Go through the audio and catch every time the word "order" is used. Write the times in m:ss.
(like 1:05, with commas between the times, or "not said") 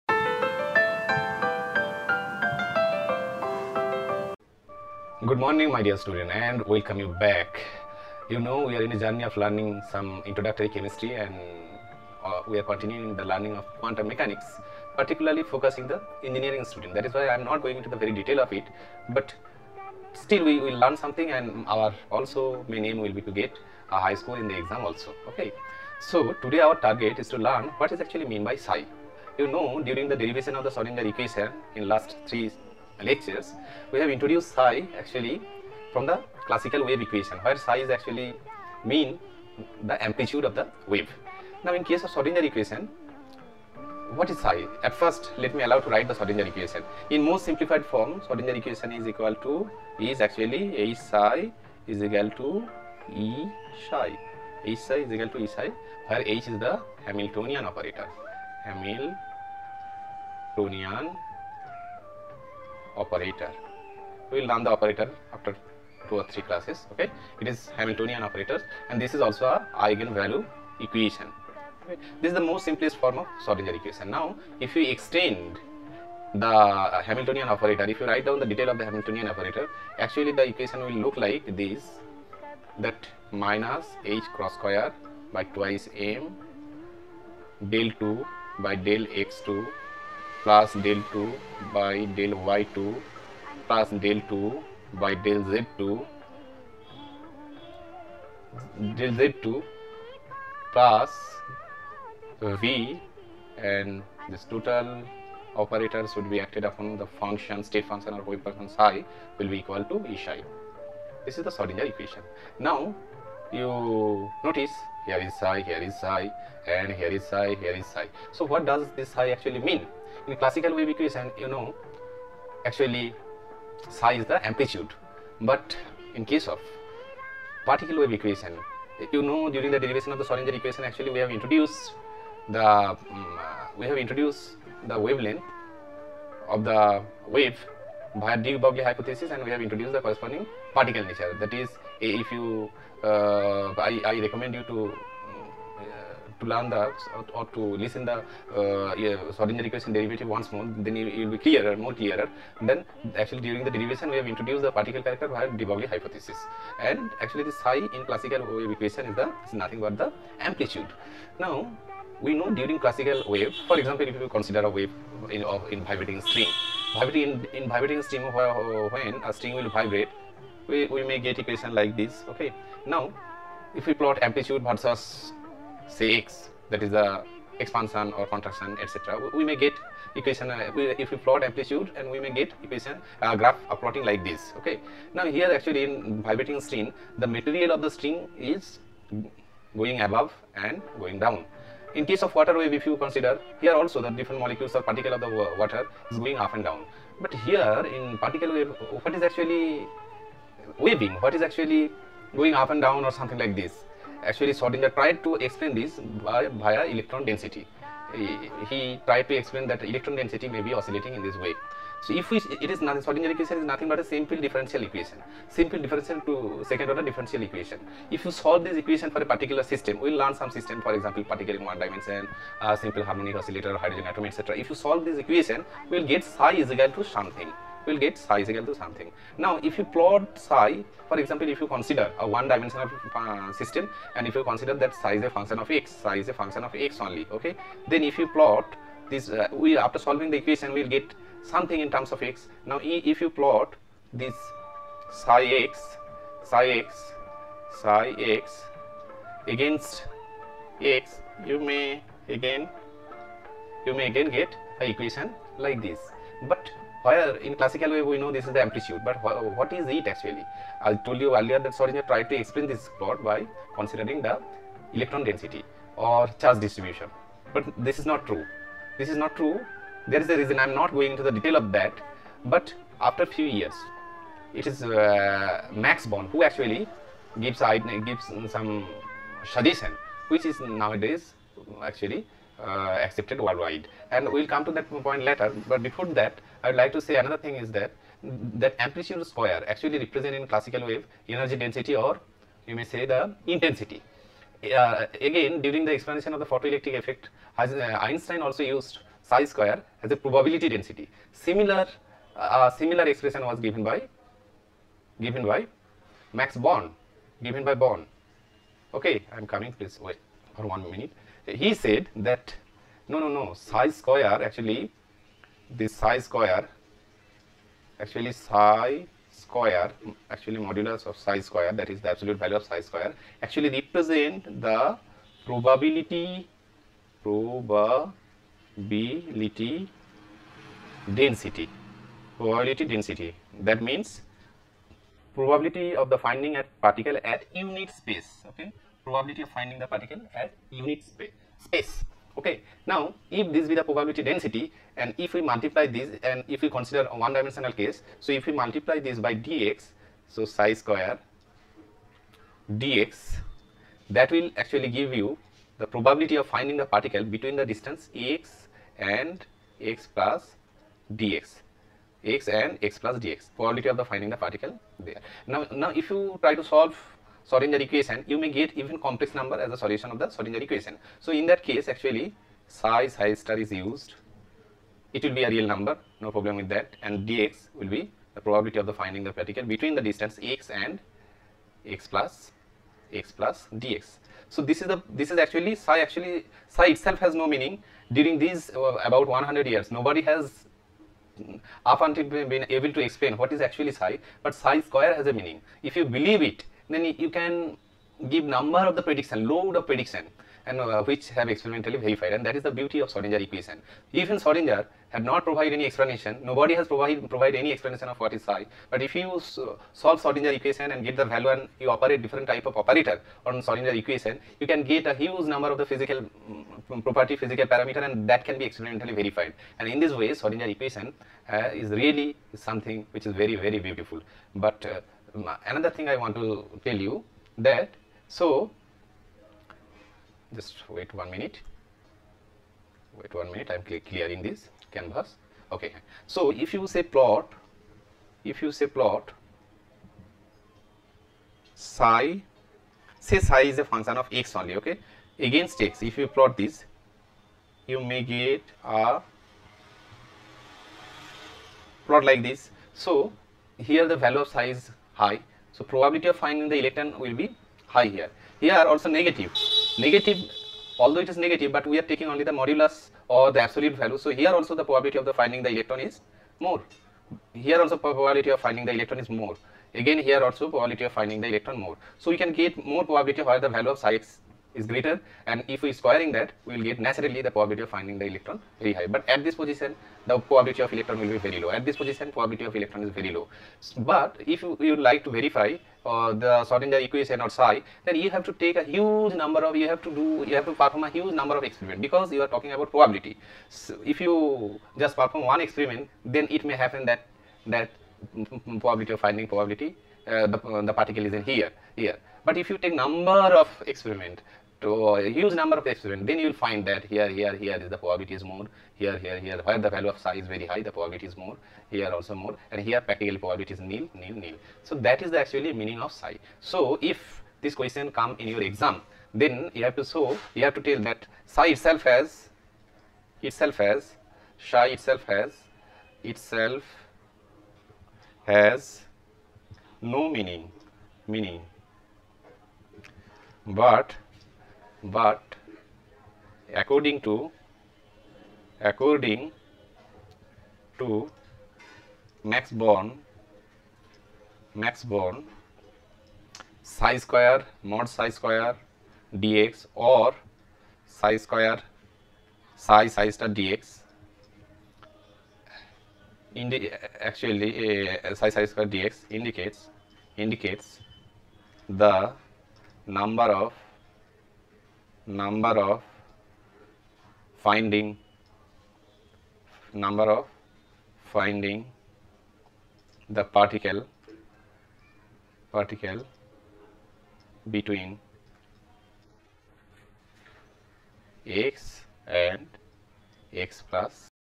3:36.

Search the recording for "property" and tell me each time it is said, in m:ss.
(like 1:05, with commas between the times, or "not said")
6:57.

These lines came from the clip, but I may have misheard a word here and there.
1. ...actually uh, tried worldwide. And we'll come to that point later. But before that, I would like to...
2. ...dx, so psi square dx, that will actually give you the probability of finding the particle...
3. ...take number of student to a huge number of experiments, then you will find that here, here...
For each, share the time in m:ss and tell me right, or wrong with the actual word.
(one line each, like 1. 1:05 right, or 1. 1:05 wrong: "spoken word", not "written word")
1. 4:41 wrong: "accepted", not "tried"
2. 5:49 right
3. 8:22 wrong: "experiment", not "student".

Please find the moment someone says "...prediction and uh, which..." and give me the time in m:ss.
6:39.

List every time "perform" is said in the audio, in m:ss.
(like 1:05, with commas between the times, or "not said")
8:10, 8:15.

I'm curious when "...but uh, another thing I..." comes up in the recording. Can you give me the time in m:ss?
7:04.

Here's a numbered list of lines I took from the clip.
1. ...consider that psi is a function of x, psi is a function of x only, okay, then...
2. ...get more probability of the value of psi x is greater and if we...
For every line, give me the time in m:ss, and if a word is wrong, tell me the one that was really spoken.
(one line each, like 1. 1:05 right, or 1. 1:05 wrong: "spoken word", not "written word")
1. 3:54 right
2. 7:52 right.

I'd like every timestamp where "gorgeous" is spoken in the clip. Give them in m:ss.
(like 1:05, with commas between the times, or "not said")
not said.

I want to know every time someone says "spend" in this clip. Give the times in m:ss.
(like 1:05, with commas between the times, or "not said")
not said.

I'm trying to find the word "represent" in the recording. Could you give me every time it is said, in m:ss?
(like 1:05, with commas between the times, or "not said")
4:49, 5:23.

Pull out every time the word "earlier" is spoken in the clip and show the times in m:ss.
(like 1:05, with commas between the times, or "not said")
4:21.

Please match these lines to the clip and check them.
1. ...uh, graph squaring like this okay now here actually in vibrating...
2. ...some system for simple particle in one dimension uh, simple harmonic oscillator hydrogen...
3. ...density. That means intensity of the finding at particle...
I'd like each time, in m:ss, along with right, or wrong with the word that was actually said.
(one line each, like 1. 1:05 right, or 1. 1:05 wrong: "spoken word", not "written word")
1. 3:03 wrong: "plotting", not "squaring"
2. 3:40 wrong: "example", not "simple"
3. 5:32 wrong: "probability", not "intensity".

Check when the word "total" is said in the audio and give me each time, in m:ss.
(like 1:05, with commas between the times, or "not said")
1:44.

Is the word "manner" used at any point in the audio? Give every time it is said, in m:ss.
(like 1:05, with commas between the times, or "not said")
not said.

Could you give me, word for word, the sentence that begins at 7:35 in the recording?
So probability of finding the electron will be high here.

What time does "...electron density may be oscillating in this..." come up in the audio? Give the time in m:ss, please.
3:29.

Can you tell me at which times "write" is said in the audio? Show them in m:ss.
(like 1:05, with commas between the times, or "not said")
0:45, 1:18.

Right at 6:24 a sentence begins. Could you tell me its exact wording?
So this is the this is actually psi actually psi itself has no meaning.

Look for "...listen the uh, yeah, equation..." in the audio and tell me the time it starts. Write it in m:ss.
2:27.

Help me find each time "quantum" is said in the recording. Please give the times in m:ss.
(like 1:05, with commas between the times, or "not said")
0:13.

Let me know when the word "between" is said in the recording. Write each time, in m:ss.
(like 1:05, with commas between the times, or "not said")
5:57, 6:19, 9:37.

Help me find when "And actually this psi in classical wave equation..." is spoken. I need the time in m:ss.
2:36.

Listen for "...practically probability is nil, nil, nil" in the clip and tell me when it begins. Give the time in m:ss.
8:32.